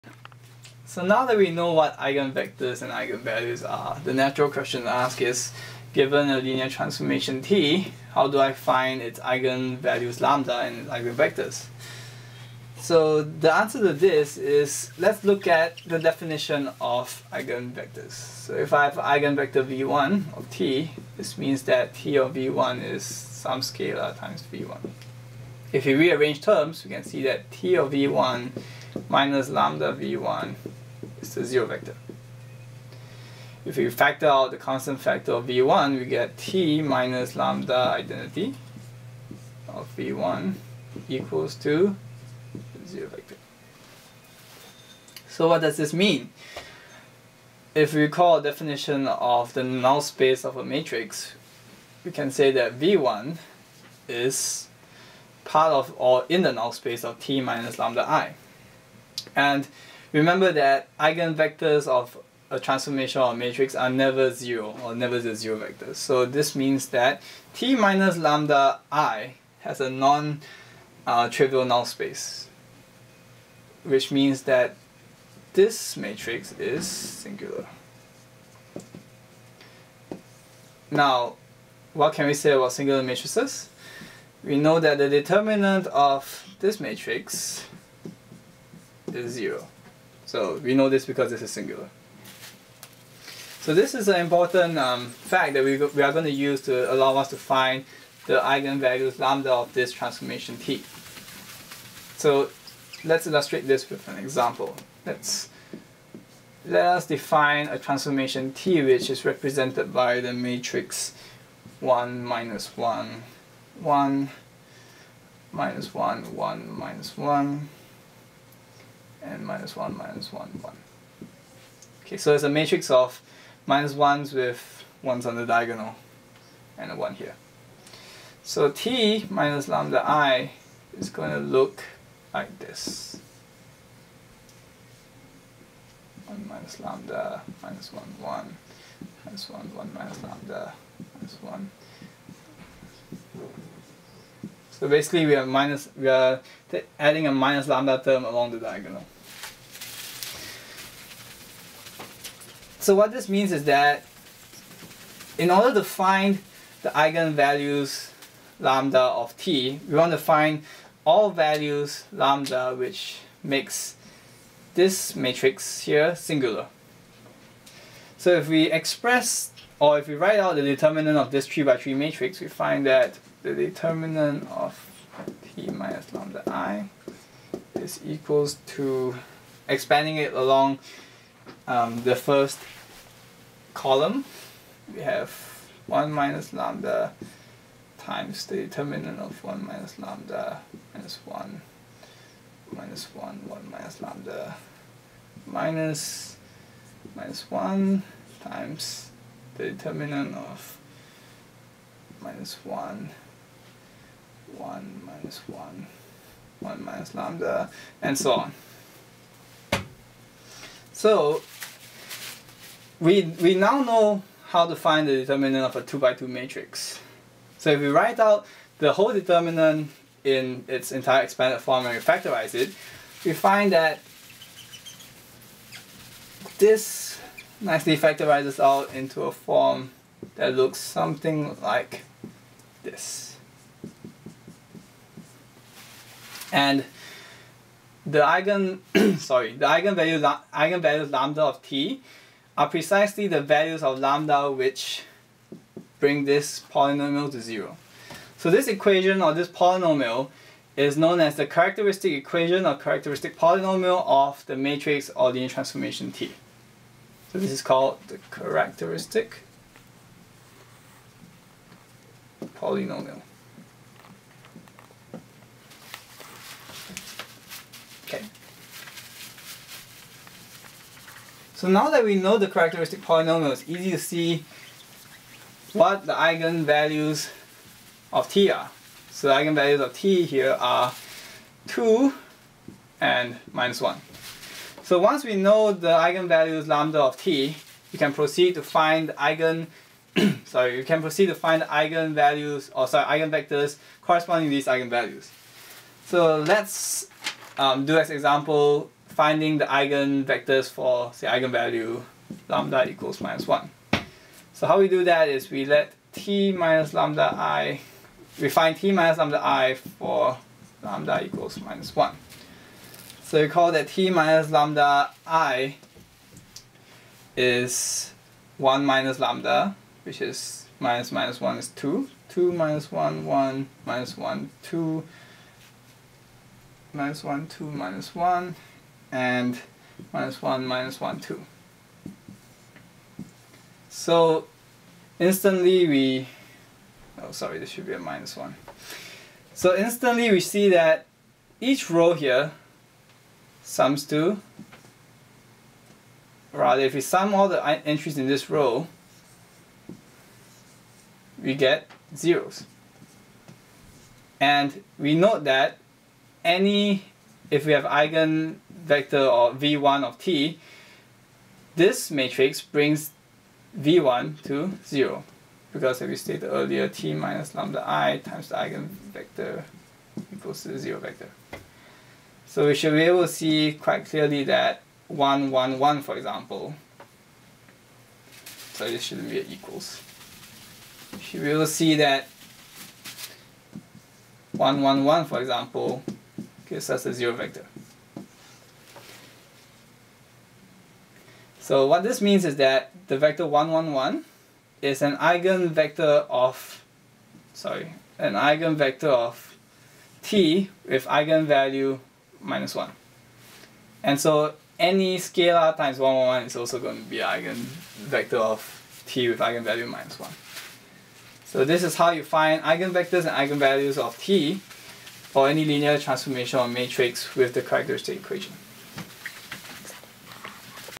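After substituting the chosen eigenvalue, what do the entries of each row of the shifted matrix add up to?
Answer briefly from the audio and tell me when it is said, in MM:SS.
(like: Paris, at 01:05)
0, at 05:51.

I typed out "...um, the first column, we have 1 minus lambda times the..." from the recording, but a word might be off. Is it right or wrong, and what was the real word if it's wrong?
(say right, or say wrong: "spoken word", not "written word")
right.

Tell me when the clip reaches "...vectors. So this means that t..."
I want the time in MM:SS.
01:05.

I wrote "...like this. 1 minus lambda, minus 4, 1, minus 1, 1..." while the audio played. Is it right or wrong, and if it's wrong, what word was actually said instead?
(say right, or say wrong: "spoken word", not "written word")
wrong: "1", not "4".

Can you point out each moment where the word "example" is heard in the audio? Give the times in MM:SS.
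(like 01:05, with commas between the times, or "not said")
01:44, 04:58, 06:16, 06:25.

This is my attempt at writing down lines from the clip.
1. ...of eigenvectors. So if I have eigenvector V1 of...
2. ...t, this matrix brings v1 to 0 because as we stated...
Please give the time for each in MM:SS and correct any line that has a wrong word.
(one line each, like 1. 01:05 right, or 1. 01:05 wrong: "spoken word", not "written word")
1. 00:16 right
2. 06:00 right.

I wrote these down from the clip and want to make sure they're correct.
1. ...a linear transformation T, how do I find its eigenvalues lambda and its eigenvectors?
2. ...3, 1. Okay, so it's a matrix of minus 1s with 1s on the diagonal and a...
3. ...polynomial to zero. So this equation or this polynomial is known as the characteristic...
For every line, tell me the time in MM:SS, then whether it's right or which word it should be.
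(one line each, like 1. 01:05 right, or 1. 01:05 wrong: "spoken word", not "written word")
1. 00:06 right
2. 02:00 wrong: "1", not "3"
3. 04:06 right.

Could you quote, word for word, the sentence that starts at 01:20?
Now, what can we say about singular matrices?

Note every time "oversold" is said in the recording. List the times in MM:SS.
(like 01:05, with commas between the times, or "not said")
not said.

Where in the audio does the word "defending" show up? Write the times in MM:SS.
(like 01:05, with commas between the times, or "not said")
not said.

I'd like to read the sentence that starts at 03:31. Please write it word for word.
So we, we now know how to find the determinant of a 2 by 2 matrix.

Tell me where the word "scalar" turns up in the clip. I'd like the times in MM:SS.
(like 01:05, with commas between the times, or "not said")
00:23, 06:45.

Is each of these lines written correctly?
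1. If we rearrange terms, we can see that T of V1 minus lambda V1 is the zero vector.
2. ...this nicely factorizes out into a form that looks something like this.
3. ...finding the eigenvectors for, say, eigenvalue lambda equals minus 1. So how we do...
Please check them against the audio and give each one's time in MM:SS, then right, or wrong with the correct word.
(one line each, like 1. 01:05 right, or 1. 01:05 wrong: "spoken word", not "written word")
1. 00:25 right
2. 03:46 right
3. 04:59 right.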